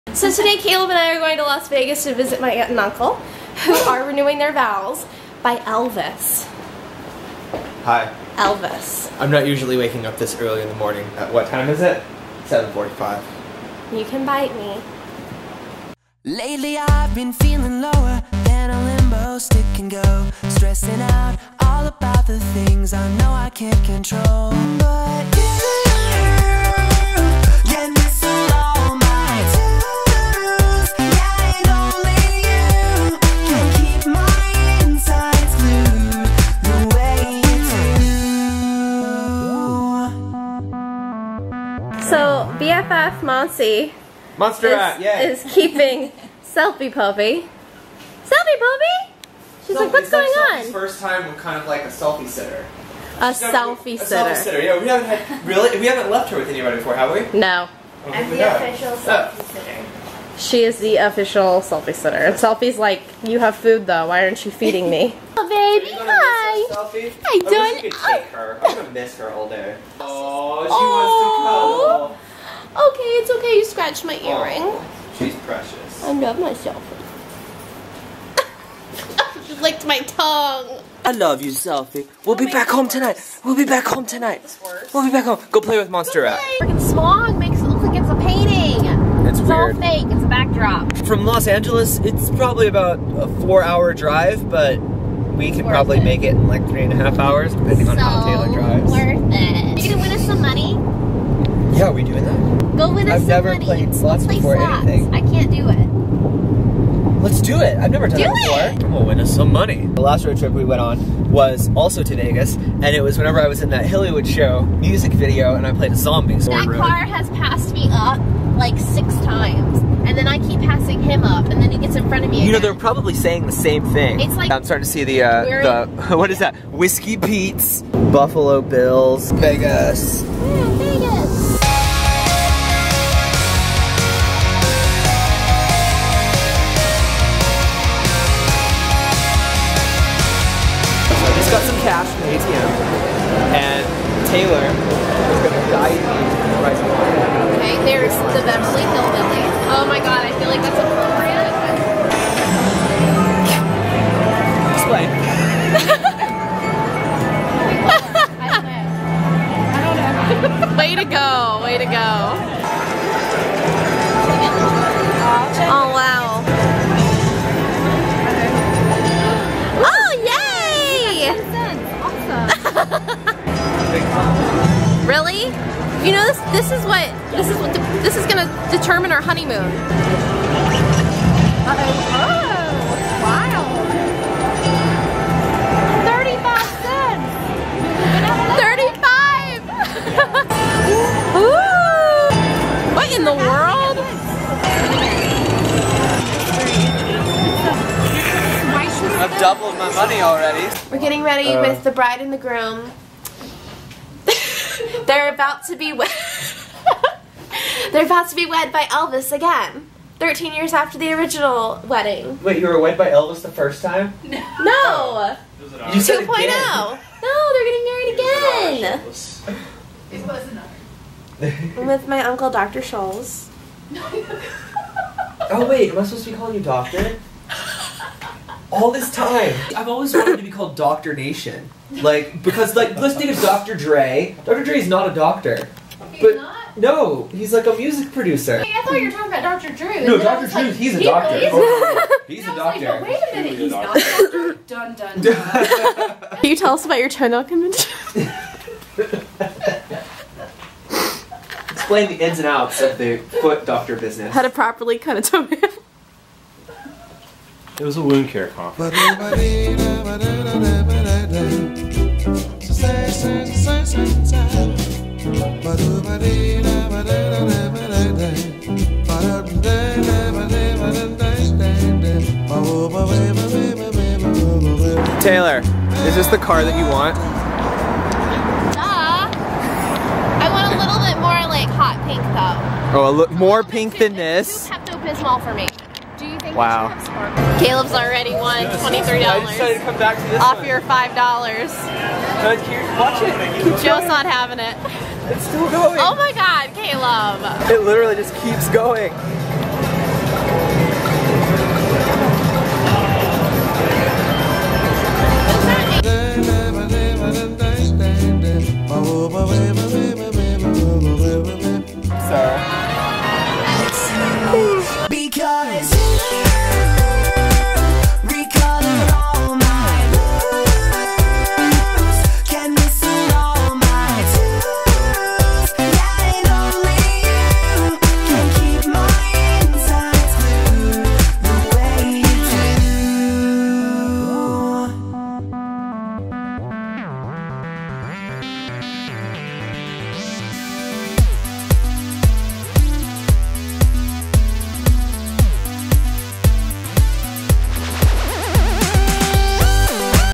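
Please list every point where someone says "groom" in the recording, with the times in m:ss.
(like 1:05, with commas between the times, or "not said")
3:22.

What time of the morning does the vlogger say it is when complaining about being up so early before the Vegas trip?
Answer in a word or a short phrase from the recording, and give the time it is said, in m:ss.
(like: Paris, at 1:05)
7:45, at 0:12.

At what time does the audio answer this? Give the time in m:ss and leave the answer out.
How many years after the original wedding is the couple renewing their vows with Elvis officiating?
3:30.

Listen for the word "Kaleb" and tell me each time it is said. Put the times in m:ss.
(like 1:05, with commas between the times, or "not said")
0:00, 4:47, 4:56.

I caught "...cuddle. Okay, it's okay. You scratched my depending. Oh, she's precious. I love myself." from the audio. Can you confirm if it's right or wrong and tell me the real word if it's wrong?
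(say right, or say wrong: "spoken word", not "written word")
wrong: "earring", not "depending".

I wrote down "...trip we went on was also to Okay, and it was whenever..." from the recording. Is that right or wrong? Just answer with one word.
wrong.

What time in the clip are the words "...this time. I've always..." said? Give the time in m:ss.
3:48.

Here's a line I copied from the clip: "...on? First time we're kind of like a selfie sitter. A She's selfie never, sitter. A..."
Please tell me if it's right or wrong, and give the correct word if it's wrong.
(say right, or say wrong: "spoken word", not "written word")
right.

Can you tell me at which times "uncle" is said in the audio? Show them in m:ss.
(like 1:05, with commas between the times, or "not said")
0:02, 3:42.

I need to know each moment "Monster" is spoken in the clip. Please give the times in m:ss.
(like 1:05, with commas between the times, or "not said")
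0:44, 1:25.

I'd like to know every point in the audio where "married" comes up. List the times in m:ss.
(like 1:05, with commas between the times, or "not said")
3:37.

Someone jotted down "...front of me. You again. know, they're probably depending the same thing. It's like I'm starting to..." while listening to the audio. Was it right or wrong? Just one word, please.
wrong.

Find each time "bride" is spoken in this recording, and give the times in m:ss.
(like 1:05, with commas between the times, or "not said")
3:21.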